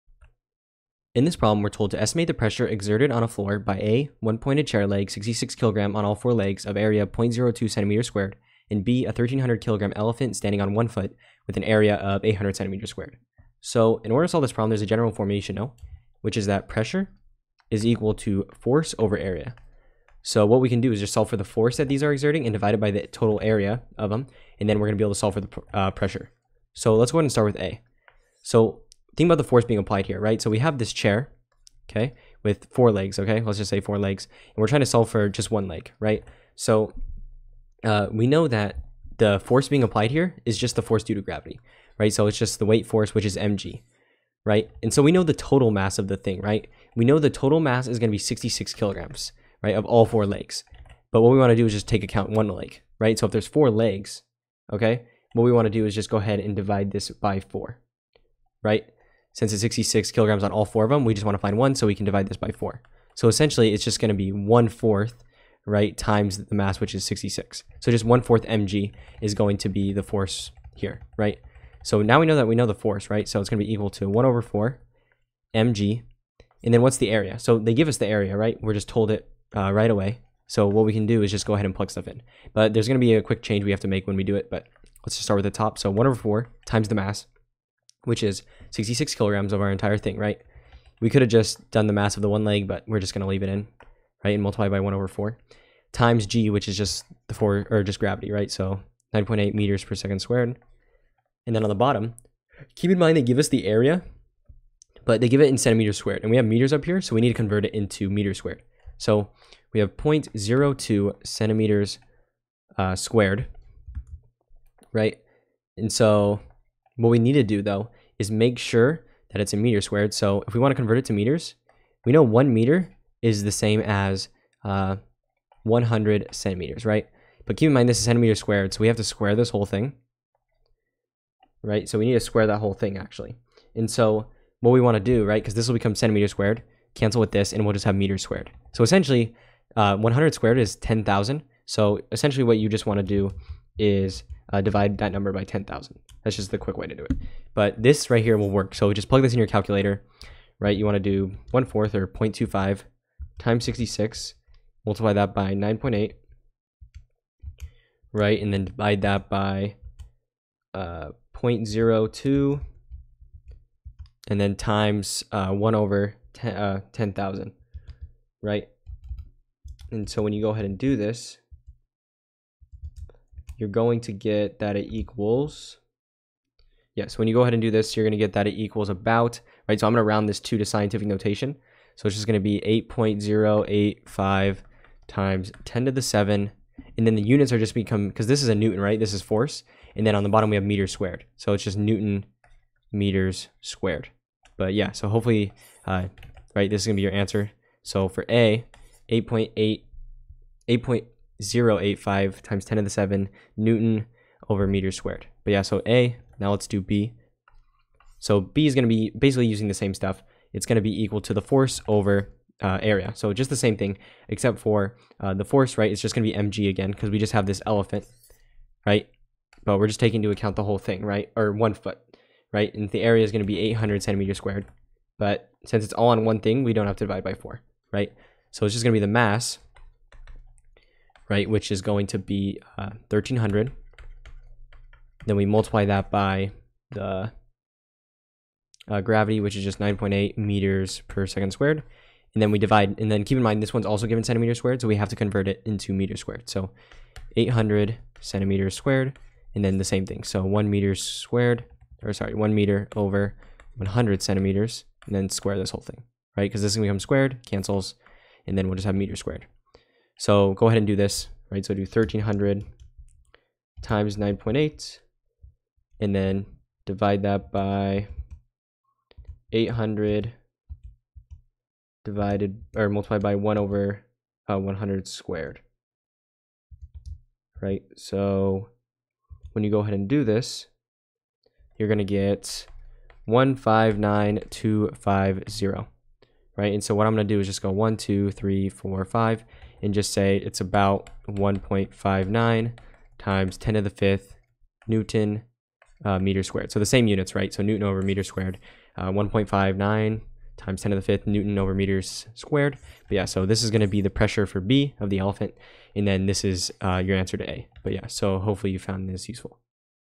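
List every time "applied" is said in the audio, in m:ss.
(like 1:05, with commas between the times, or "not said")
0:29, 0:39.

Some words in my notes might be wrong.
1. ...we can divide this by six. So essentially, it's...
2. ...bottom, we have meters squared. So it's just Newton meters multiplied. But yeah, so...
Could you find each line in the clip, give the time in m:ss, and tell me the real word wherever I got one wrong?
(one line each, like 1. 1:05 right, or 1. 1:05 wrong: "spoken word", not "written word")
1. 1:01 wrong: "four", not "six"
2. 3:10 wrong: "squared", not "multiplied".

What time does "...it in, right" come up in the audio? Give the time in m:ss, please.
1:33.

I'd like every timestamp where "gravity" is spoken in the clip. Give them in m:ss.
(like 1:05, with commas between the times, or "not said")
0:41, 1:37, 3:59.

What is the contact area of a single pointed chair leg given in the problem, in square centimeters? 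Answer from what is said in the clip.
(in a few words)
0.02 cm squared.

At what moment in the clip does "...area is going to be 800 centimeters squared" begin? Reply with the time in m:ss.
3:43.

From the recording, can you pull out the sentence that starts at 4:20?
So go ahead and do this, right?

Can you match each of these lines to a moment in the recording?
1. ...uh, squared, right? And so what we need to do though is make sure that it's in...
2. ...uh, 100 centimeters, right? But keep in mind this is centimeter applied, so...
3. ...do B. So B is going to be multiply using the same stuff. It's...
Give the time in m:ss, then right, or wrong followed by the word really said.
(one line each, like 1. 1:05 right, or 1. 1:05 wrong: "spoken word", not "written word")
1. 1:52 right
2. 2:04 wrong: "squared", not "applied"
3. 3:26 wrong: "basically", not "multiply".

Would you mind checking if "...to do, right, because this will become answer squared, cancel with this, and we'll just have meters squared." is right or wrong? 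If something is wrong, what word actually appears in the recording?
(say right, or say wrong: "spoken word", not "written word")
wrong: "centimeter", not "answer".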